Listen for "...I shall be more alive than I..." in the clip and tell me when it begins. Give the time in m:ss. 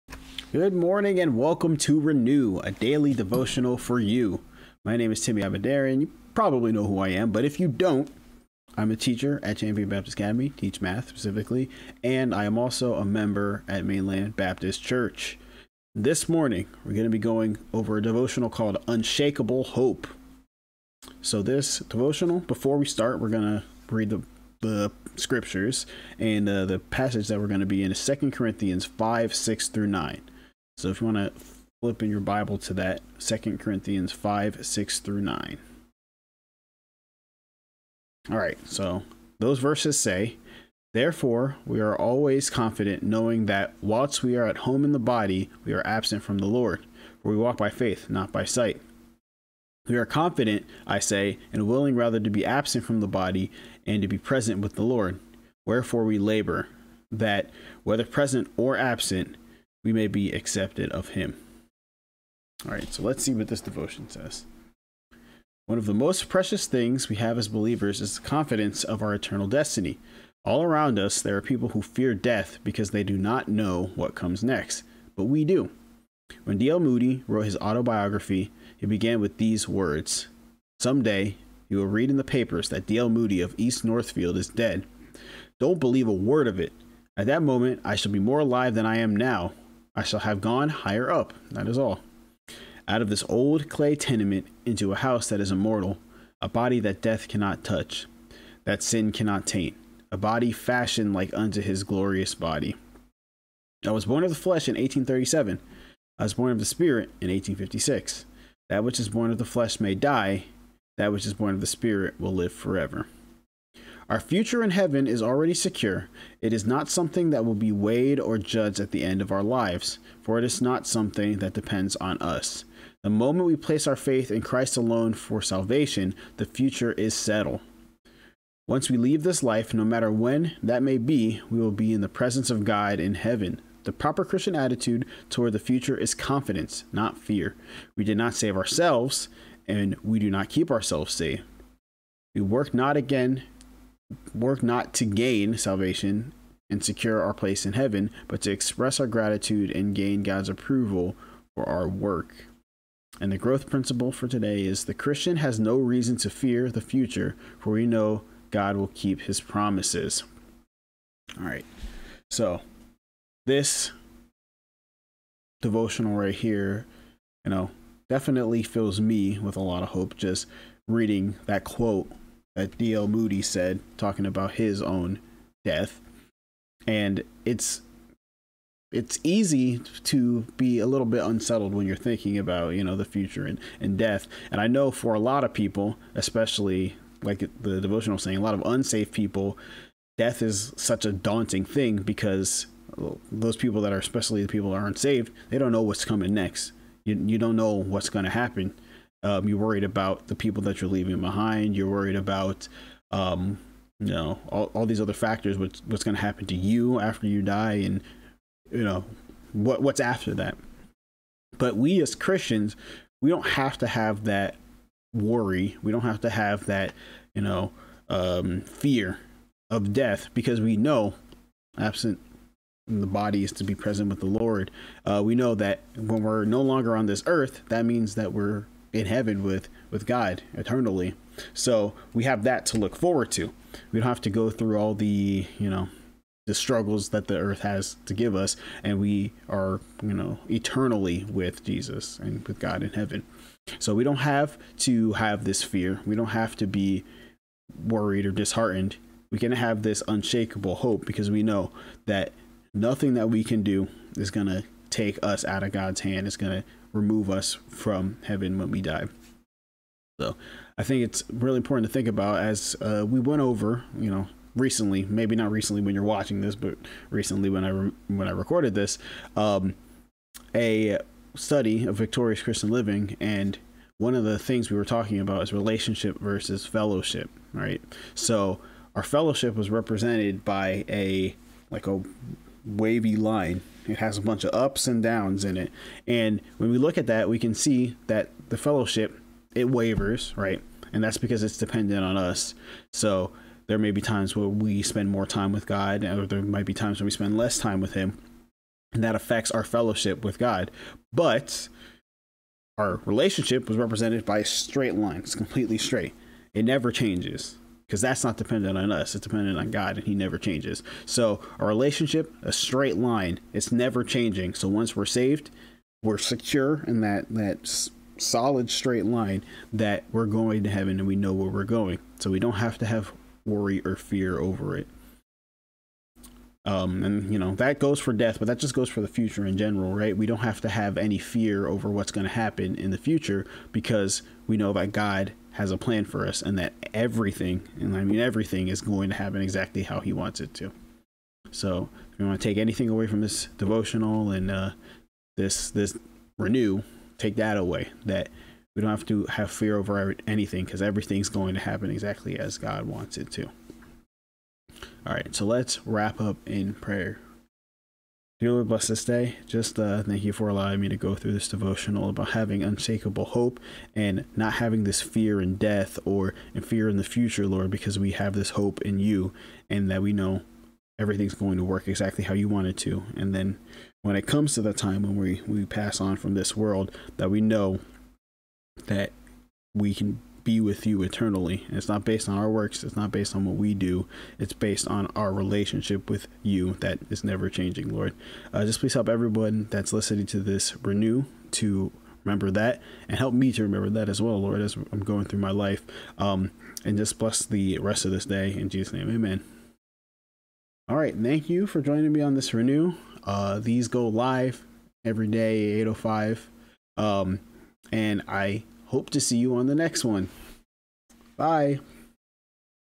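1:27.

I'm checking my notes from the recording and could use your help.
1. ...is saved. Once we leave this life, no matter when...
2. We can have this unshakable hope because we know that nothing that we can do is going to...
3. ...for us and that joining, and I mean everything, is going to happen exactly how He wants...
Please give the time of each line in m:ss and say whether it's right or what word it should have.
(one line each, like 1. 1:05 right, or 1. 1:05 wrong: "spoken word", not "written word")
1. 2:06 wrong: "settled", not "saved"
2. 4:09 right
3. 5:36 wrong: "everything", not "joining".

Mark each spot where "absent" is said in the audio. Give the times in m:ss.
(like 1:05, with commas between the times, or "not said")
0:45, 0:52, 0:58, 3:41.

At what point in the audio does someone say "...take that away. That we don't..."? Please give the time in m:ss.
5:47.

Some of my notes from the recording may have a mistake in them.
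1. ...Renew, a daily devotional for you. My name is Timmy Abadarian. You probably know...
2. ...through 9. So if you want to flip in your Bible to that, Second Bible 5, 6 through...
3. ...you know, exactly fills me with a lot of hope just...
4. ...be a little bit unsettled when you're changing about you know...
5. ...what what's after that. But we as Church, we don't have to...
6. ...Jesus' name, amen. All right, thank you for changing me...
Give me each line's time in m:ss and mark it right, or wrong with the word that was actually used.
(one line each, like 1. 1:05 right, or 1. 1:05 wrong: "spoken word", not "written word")
1. 0:02 right
2. 0:29 wrong: "Corinthians", not "Bible"
3. 2:47 wrong: "definitely", not "exactly"
4. 3:00 wrong: "thinking", not "changing"
5. 3:29 wrong: "Christians", not "Church"
6. 6:38 wrong: "joining", not "changing".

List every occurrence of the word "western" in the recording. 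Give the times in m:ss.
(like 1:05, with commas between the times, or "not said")
not said.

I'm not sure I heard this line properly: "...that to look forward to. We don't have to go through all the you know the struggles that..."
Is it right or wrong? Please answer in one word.
right.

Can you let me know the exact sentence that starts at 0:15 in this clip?
This morning, we're going to be going over a devotional called Unshakable Hope.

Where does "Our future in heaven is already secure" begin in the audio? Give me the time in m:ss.
1:54.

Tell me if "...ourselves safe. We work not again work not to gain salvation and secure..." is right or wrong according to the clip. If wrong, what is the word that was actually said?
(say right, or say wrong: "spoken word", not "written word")
right.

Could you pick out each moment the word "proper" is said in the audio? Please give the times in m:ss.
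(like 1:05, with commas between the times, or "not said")
2:13.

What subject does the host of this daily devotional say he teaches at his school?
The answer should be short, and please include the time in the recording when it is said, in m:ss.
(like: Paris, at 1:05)
Math, at 0:10.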